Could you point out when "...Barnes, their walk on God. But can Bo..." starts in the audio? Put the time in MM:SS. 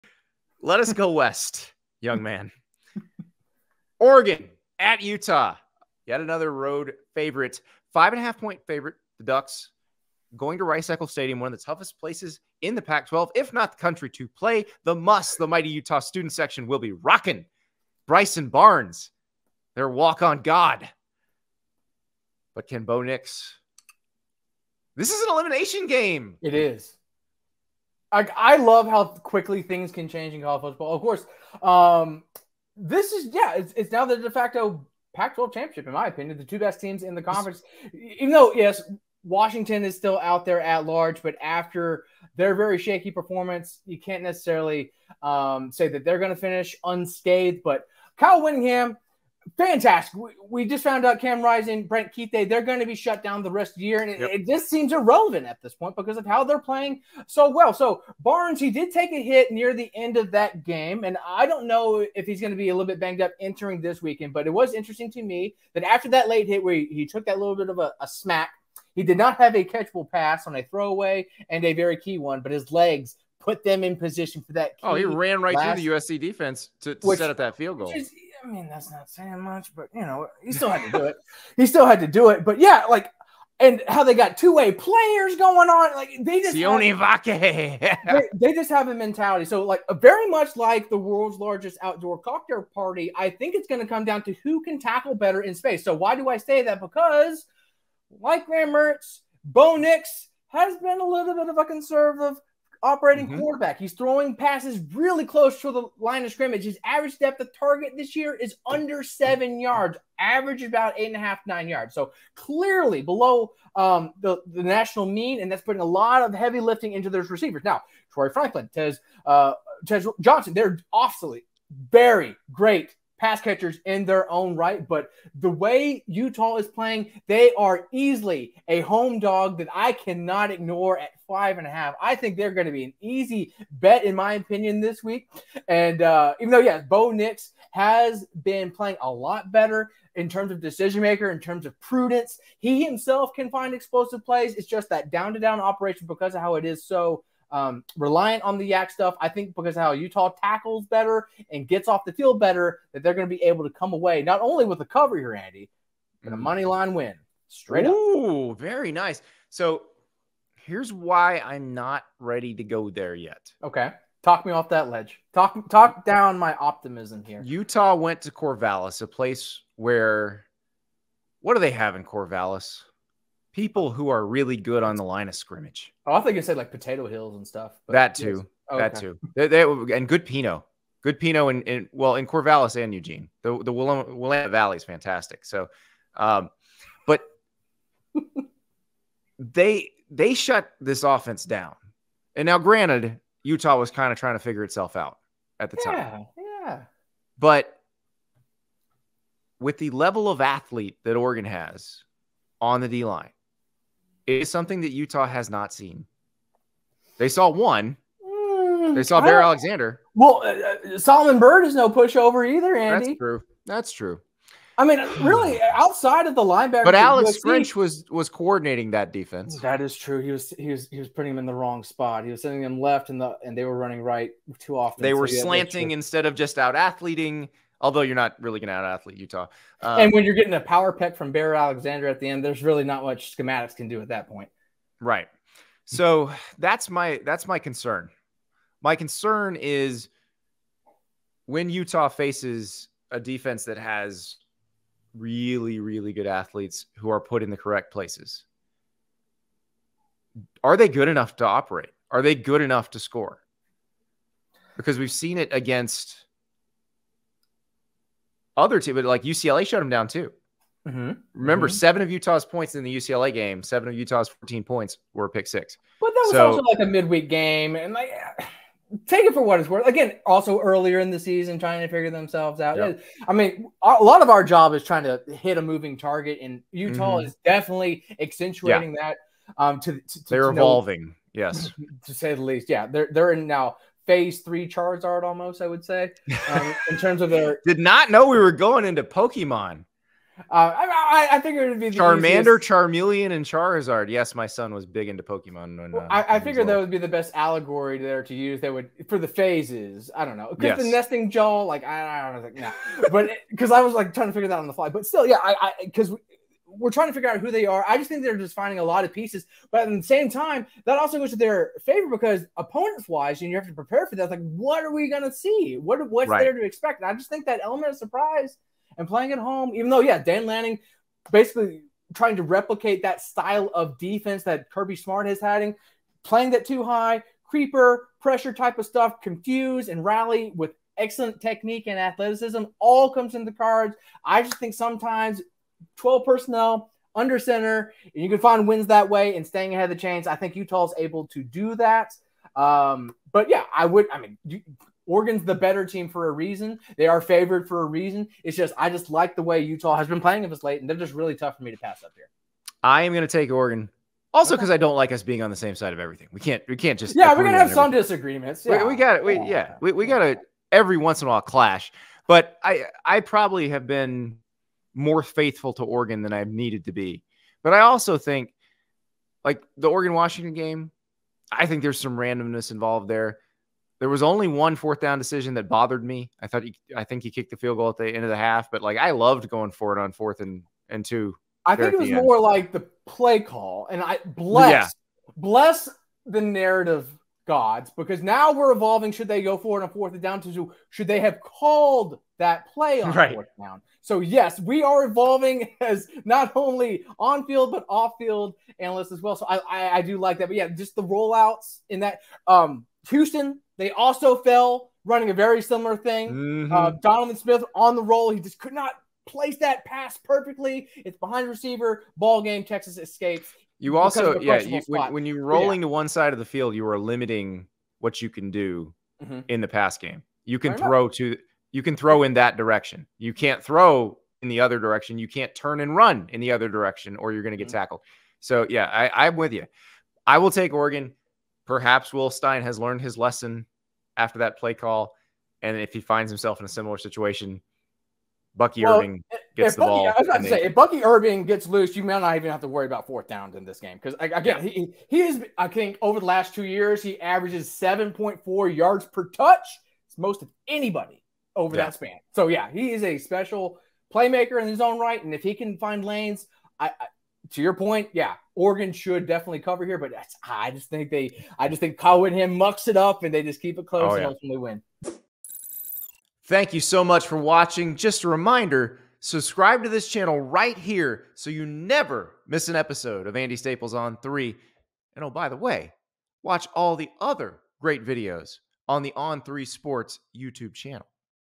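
00:18.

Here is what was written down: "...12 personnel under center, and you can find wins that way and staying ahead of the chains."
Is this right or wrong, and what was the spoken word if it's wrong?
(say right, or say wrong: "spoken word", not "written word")
right.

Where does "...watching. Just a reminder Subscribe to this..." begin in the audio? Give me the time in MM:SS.
07:47.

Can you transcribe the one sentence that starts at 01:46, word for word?
His average depth of target this year is under seven yards, average about eight and a half, nine yards.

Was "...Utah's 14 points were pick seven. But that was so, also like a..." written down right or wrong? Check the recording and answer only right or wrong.
wrong.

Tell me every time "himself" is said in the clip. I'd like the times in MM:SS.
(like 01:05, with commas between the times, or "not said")
02:22, 07:16.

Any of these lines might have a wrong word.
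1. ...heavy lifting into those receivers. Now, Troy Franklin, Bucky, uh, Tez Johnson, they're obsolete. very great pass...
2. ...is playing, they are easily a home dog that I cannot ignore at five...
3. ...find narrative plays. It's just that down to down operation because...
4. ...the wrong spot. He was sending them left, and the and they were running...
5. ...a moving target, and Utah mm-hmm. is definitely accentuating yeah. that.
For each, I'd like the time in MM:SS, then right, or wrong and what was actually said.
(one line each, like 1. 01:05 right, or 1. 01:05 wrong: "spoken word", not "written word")
1. 01:56 wrong: "Tez", not "Bucky"
2. 02:06 right
3. 02:23 wrong: "explosive", not "narrative"
4. 03:41 right
5. 04:35 right.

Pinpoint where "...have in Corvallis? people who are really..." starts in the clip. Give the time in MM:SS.
02:51.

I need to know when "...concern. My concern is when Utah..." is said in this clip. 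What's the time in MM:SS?
03:57.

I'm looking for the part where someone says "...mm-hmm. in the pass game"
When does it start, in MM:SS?
06:59.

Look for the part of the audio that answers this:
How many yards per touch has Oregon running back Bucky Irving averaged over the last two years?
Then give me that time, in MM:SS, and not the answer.
07:27.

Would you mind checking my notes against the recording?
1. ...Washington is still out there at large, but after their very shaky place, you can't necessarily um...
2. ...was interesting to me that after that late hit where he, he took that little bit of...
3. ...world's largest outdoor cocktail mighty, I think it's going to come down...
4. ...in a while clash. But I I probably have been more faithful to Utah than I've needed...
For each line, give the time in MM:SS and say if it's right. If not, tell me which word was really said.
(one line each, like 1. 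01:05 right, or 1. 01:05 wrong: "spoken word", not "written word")
1. 00:39 wrong: "performance", not "place"
2. 01:04 right
3. 01:30 wrong: "party", not "mighty"
4. 06:01 wrong: "Oregon", not "Utah".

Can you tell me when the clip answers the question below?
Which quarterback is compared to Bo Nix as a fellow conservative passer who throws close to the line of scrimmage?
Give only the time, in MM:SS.
01:38.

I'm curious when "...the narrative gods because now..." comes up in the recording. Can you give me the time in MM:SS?
06:26.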